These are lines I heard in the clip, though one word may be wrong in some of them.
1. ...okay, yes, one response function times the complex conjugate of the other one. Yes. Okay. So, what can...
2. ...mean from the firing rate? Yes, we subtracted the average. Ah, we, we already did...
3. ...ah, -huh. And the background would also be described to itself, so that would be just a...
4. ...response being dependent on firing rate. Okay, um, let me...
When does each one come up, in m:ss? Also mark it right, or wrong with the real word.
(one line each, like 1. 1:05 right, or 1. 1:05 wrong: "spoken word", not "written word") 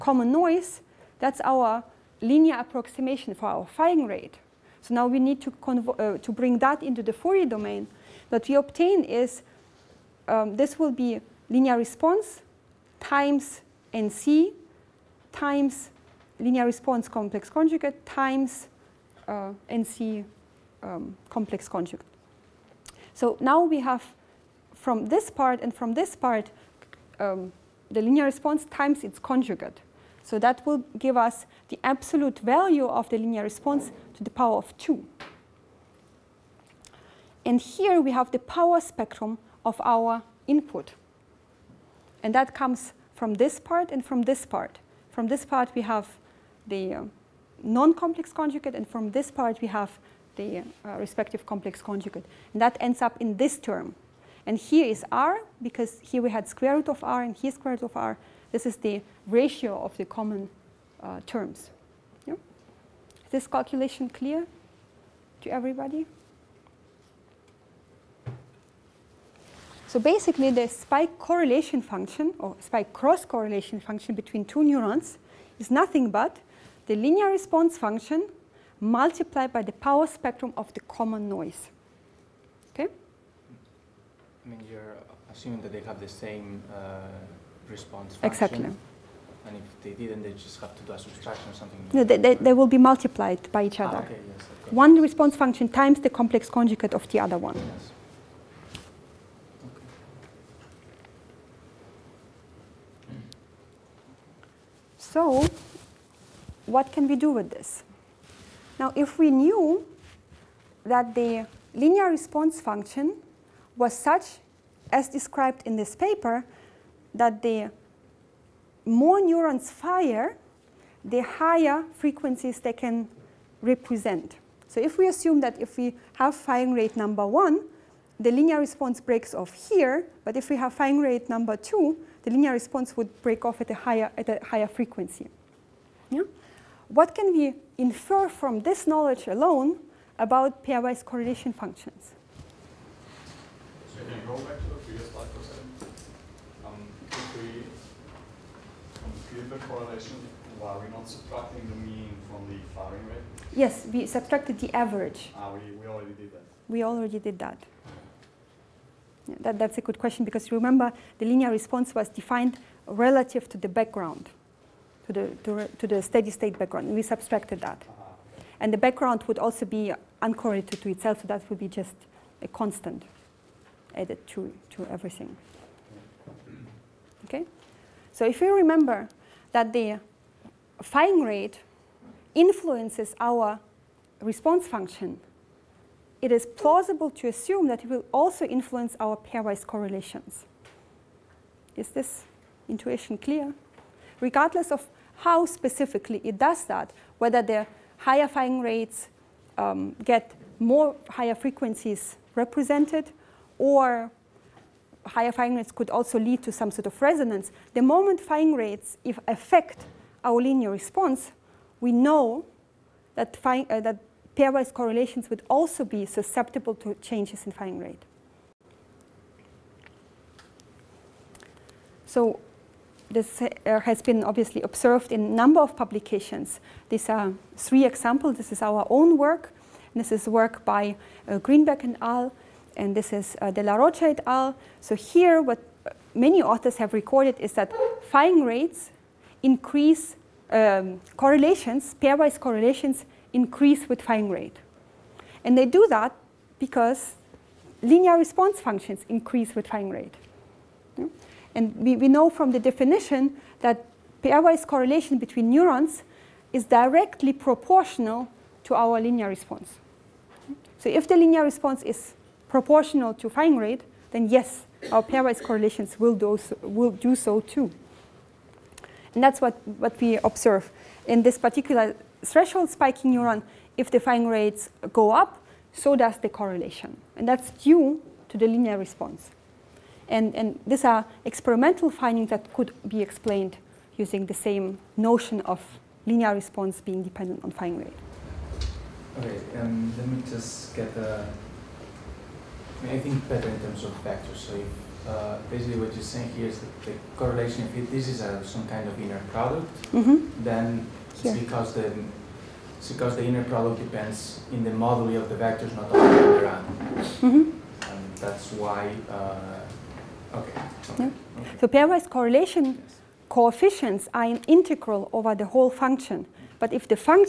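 1. 1:34 right
2. 2:31 right
3. 2:47 wrong: "uncorrelated", not "described"
4. 4:46 right.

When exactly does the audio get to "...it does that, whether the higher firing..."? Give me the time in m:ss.
3:16.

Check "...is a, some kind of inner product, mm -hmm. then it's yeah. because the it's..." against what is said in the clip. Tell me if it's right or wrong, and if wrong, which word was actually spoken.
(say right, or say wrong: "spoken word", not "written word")
right.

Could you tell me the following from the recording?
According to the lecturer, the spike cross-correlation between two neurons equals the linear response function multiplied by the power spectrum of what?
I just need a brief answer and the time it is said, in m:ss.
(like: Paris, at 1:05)
the common noise, at 1:20.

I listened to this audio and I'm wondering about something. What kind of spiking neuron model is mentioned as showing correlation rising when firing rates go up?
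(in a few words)
threshold spiking neuron.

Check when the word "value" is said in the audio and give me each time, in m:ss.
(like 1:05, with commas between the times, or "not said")
0:32.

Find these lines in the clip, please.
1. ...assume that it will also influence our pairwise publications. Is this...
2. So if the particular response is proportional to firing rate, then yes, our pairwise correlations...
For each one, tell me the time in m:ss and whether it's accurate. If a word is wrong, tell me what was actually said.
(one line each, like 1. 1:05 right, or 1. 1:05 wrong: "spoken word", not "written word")
1. 3:07 wrong: "correlations", not "publications"
2. 4:20 wrong: "linear", not "particular".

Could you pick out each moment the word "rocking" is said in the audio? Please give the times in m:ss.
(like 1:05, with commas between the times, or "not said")
not said.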